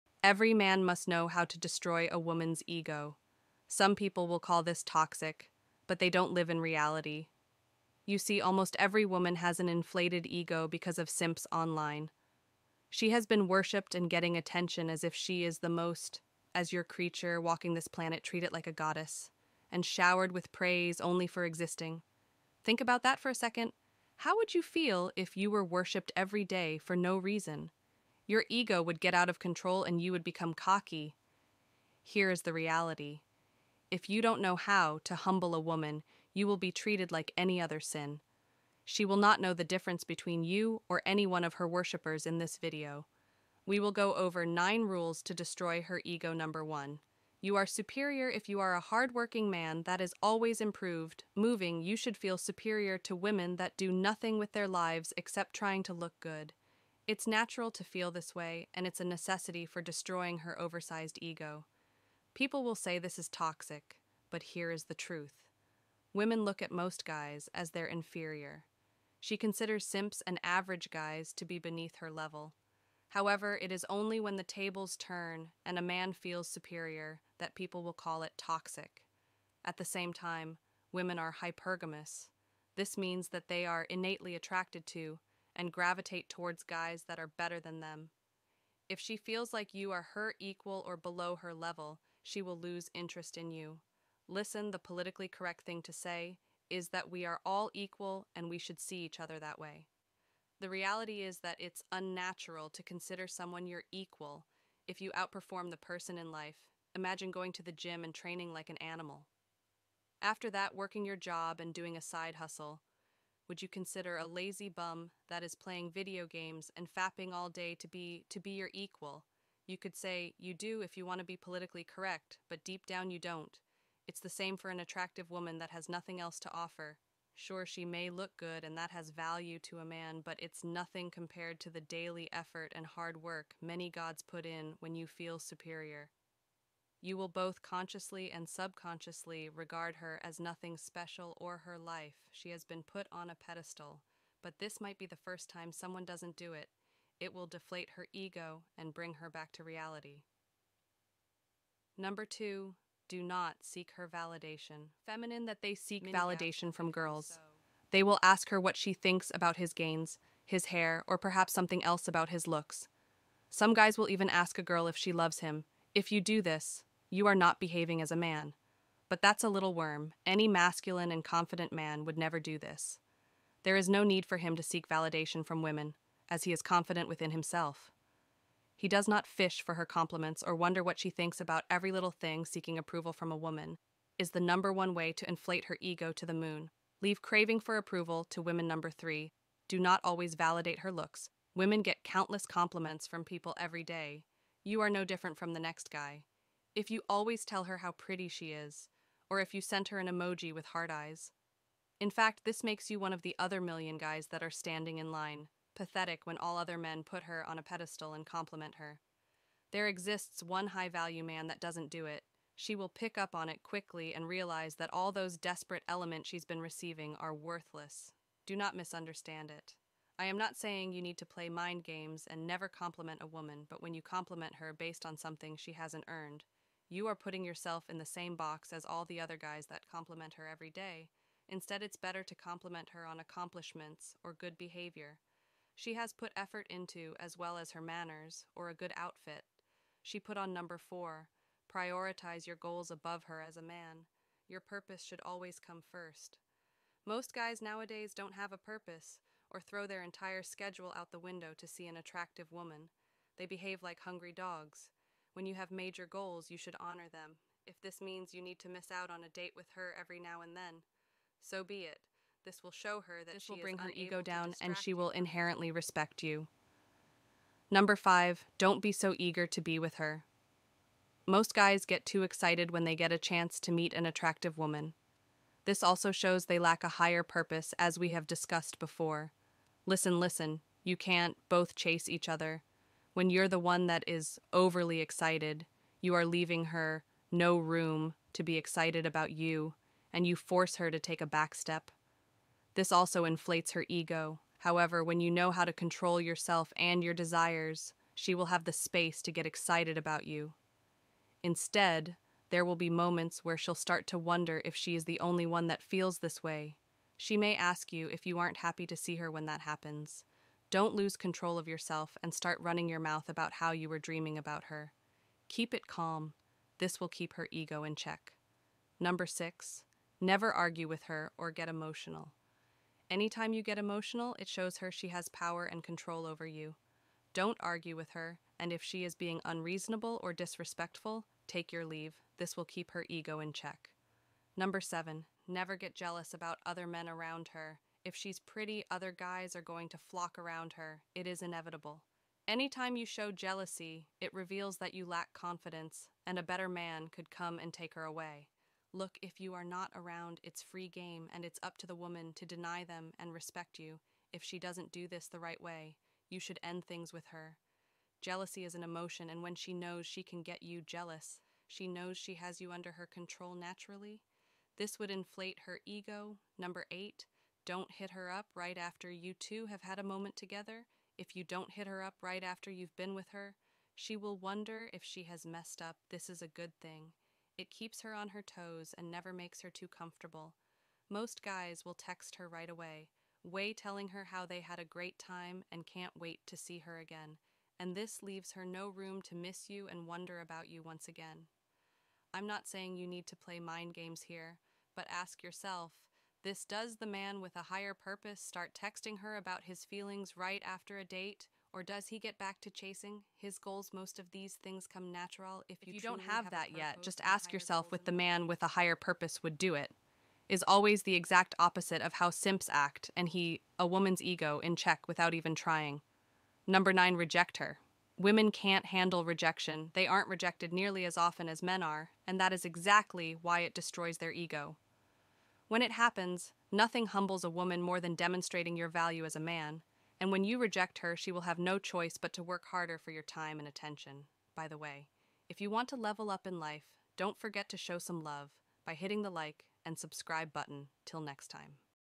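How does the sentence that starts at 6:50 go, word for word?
Is always the exact opposite of how simps act, and he, a woman's ego, in check without even trying.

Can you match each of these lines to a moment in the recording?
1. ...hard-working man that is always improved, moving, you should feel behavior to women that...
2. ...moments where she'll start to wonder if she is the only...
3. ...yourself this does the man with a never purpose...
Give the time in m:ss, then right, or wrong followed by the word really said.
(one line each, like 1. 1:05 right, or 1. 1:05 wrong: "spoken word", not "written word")
1. 0:48 wrong: "superior", not "behavior"
2. 5:02 right
3. 6:35 wrong: "higher", not "never".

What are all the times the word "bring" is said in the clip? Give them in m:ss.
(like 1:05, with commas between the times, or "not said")
2:28, 4:23.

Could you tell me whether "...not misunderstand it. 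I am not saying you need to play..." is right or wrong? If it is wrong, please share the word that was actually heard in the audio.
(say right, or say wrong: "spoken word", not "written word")
right.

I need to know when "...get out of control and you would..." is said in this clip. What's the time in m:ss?
0:29.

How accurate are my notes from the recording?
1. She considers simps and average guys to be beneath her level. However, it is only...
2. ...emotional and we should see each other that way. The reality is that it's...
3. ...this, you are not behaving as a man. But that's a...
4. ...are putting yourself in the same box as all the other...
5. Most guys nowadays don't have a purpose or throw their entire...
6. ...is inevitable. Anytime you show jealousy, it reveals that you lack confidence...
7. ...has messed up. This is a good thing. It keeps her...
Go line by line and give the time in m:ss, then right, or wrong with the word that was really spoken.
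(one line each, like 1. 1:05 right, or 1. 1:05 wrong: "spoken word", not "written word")
1. 1:09 right
2. 1:37 wrong: "equal", not "emotional"
3. 2:46 right
4. 3:47 right
5. 4:07 right
6. 5:41 right
7. 6:15 right.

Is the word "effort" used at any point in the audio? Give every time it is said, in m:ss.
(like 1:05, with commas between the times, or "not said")
2:12, 3:56.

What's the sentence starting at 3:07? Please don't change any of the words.
Leave craving for approval to women number three.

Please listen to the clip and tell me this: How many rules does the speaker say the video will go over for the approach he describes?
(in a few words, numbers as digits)
9.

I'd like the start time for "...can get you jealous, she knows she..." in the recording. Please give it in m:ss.
6:00.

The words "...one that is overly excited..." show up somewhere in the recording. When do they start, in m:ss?
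4:43.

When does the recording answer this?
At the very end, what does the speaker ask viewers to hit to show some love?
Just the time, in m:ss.
7:19.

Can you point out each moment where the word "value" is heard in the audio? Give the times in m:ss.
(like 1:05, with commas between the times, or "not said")
2:09, 3:30, 7:08.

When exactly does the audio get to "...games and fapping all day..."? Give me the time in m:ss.
1:56.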